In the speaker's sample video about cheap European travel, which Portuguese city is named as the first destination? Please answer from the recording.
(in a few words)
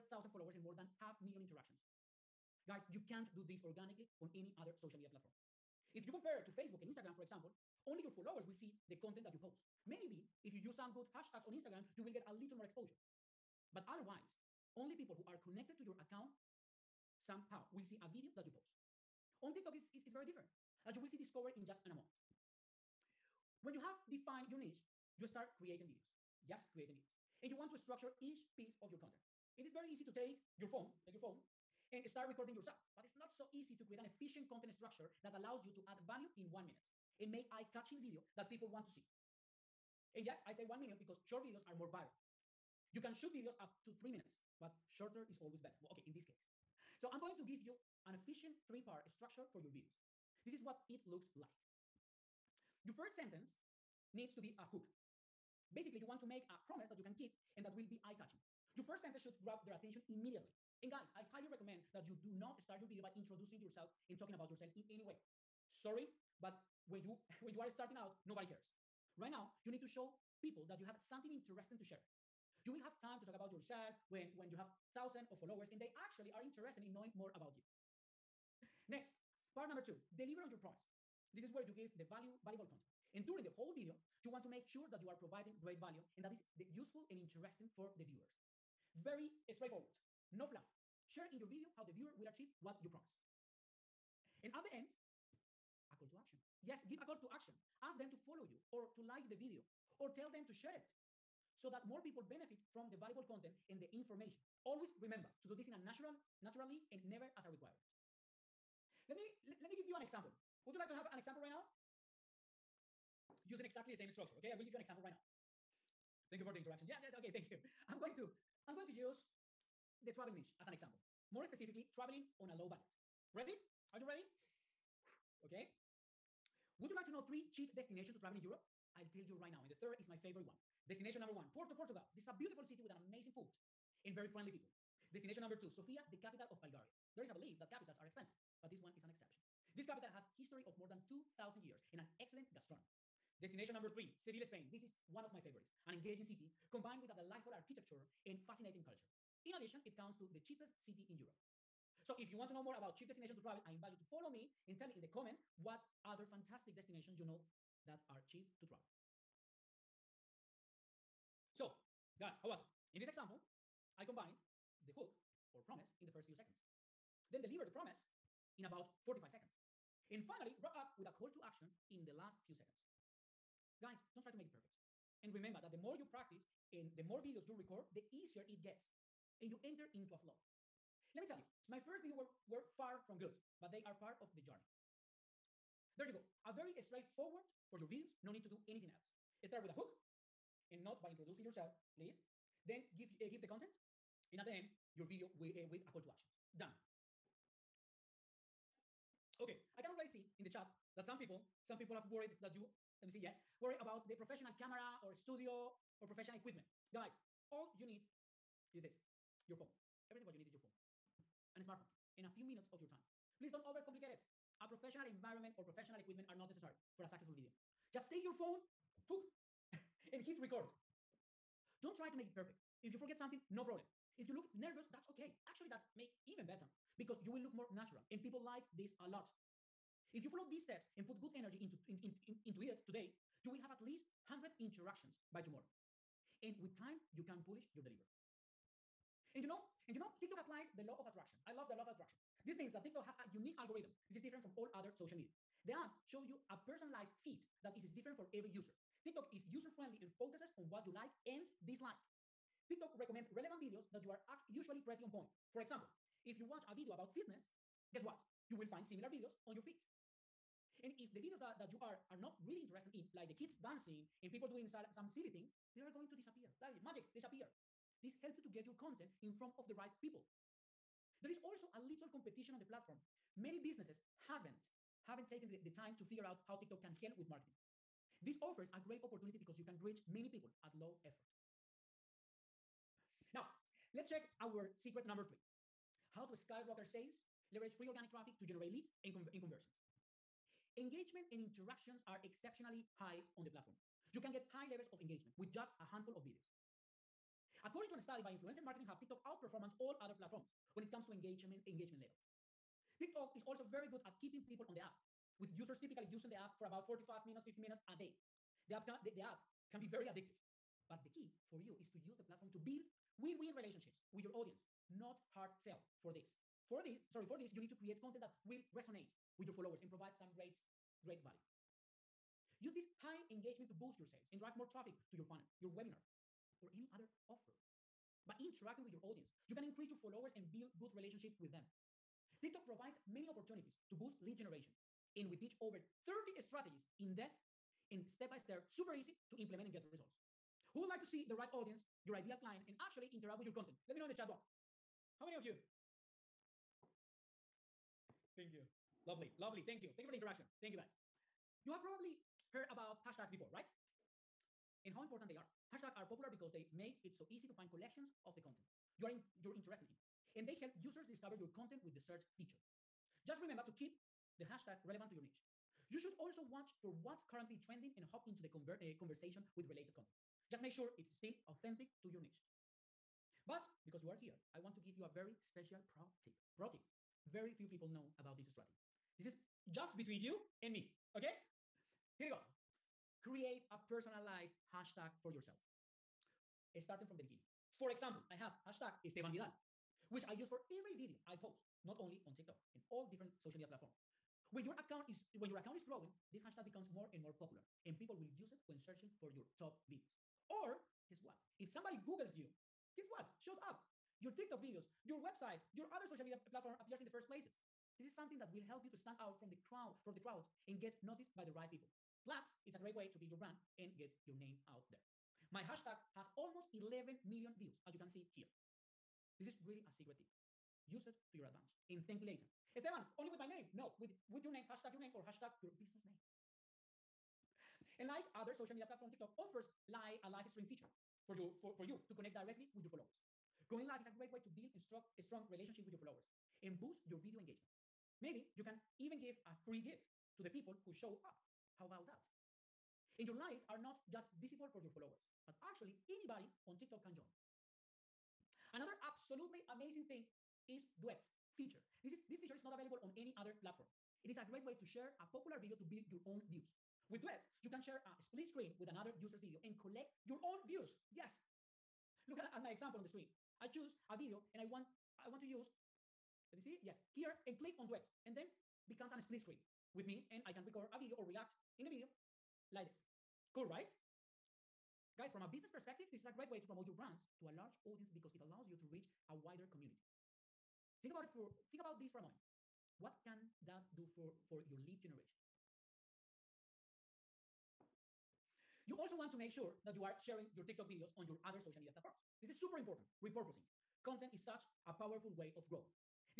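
Porto.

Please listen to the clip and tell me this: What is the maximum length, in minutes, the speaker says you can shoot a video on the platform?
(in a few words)
3 minutes.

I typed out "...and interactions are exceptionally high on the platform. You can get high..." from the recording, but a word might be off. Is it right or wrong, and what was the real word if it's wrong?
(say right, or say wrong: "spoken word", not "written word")
right.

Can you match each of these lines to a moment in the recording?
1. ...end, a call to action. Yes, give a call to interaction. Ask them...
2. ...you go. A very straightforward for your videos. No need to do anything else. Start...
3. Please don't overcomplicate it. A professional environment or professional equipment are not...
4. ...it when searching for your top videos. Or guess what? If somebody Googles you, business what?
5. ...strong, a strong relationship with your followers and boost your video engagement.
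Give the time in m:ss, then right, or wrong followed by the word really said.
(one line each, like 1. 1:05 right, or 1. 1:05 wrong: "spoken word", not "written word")
1. 1:34 wrong: "action", not "interaction"
2. 3:06 right
3. 3:33 right
4. 6:38 wrong: "guess", not "business"
5. 7:14 right.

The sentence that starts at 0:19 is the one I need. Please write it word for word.
On TikTok is, is, is very different, as you will see discovered in just in a moment.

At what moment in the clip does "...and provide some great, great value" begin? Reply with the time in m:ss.
5:19.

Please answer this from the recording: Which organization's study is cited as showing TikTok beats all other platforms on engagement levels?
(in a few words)
Influencer Marketing Hub.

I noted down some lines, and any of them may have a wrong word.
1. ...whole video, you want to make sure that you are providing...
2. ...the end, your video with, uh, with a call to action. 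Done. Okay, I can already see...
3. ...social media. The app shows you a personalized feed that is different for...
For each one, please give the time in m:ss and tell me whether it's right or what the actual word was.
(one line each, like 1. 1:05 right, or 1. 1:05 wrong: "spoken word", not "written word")
1. 1:23 right
2. 3:14 right
3. 4:04 right.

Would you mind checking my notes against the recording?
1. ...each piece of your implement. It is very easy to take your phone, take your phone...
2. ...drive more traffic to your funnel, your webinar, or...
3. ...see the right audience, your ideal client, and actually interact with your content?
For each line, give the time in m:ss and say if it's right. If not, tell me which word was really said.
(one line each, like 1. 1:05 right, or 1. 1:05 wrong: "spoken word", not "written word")
1. 0:28 wrong: "content", not "implement"
2. 5:24 right
3. 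5:41 right.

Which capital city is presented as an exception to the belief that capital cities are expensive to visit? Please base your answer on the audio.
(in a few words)
Sofia.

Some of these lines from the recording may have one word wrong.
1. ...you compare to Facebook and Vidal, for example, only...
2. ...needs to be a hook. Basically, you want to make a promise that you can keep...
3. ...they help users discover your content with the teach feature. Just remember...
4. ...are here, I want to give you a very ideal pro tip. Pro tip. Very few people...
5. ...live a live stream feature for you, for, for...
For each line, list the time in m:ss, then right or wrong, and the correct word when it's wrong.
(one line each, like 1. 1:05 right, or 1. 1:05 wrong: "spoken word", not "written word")
1. 0:06 wrong: "Instagram", not "Vidal"
2. 0:54 right
3. 6:00 wrong: "search", not "teach"
4. 6:14 wrong: "special", not "ideal"
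5. 7:09 right.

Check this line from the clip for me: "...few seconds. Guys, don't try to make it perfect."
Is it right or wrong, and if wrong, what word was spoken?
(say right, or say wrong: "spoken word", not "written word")
right.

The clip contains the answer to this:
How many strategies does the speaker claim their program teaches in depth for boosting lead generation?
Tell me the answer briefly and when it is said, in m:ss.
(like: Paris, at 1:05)
over 30, at 5:35.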